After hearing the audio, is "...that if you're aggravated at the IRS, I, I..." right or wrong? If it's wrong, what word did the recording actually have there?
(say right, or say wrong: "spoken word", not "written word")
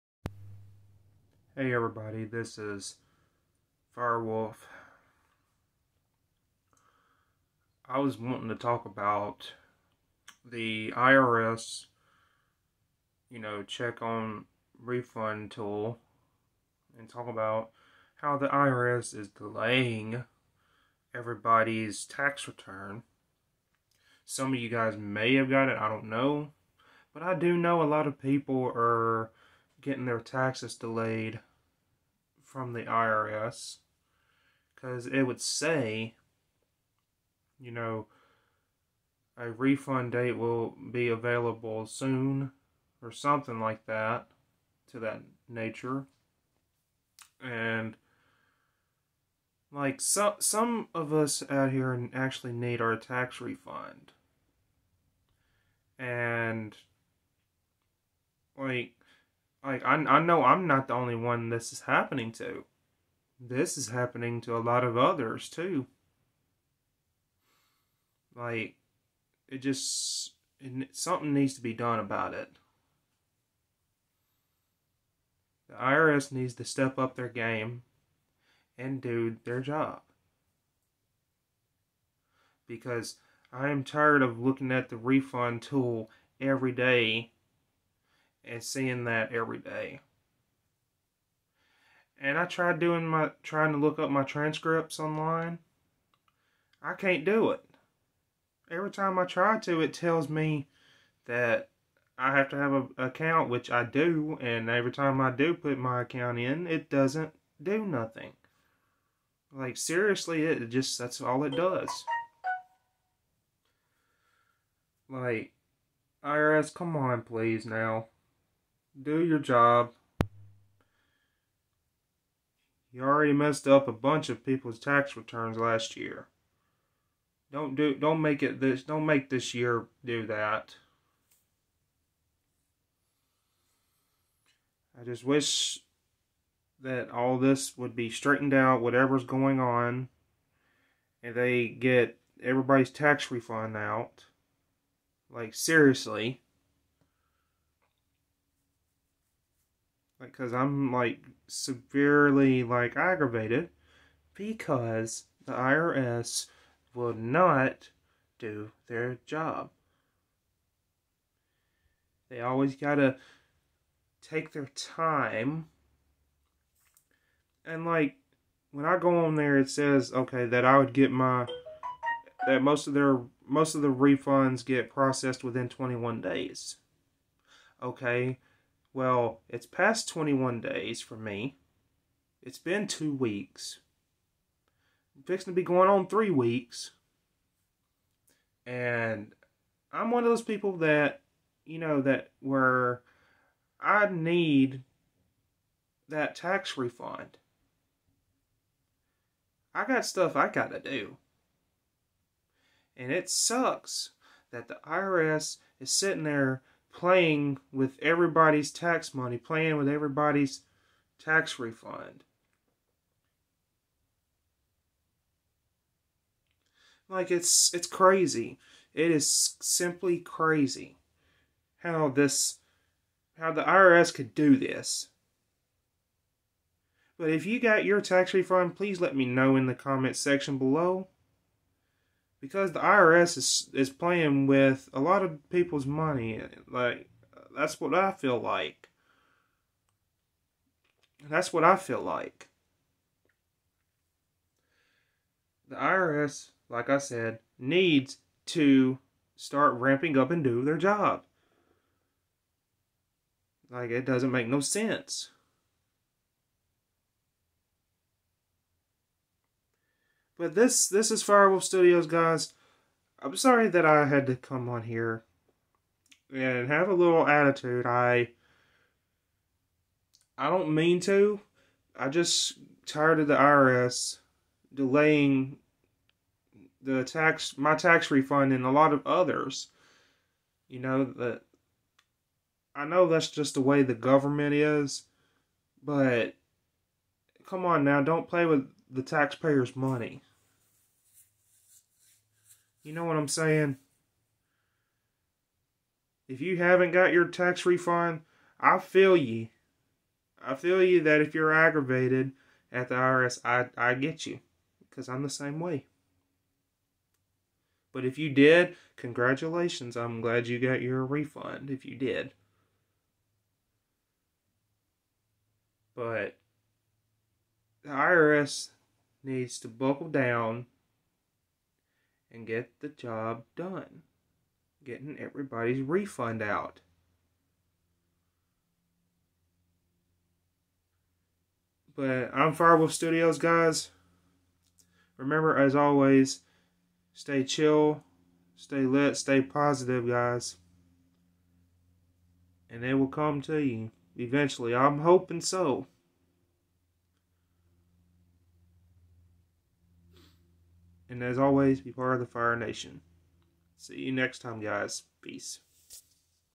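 right.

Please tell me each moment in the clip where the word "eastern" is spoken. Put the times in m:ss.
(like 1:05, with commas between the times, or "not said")
not said.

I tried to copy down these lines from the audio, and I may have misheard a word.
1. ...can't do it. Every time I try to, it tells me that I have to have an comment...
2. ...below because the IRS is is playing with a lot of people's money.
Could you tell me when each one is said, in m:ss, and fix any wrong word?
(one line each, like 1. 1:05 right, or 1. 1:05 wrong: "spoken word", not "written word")
1. 1:36 wrong: "account", not "comment"
2. 3:50 right.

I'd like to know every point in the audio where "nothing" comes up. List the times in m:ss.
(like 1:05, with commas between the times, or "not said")
1:47.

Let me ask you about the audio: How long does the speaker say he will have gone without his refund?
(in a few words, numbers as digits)
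three weeks.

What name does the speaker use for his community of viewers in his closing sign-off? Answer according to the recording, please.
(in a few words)
Fire Nation.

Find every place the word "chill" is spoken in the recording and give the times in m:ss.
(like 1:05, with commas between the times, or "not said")
5:37.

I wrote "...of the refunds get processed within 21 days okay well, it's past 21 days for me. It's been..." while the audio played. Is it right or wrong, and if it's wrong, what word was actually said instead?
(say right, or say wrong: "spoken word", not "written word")
right.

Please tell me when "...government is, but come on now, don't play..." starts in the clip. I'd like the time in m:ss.
4:43.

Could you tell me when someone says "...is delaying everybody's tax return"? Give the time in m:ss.
0:19.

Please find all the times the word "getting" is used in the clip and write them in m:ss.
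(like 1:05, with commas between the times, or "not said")
0:29, 5:24.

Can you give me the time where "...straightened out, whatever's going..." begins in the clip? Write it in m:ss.
2:18.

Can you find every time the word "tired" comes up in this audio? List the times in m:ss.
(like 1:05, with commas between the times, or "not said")
1:23, 4:32.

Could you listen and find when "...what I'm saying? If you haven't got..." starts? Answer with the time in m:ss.
4:53.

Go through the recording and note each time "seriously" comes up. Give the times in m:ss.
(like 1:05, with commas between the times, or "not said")
1:49, 2:25.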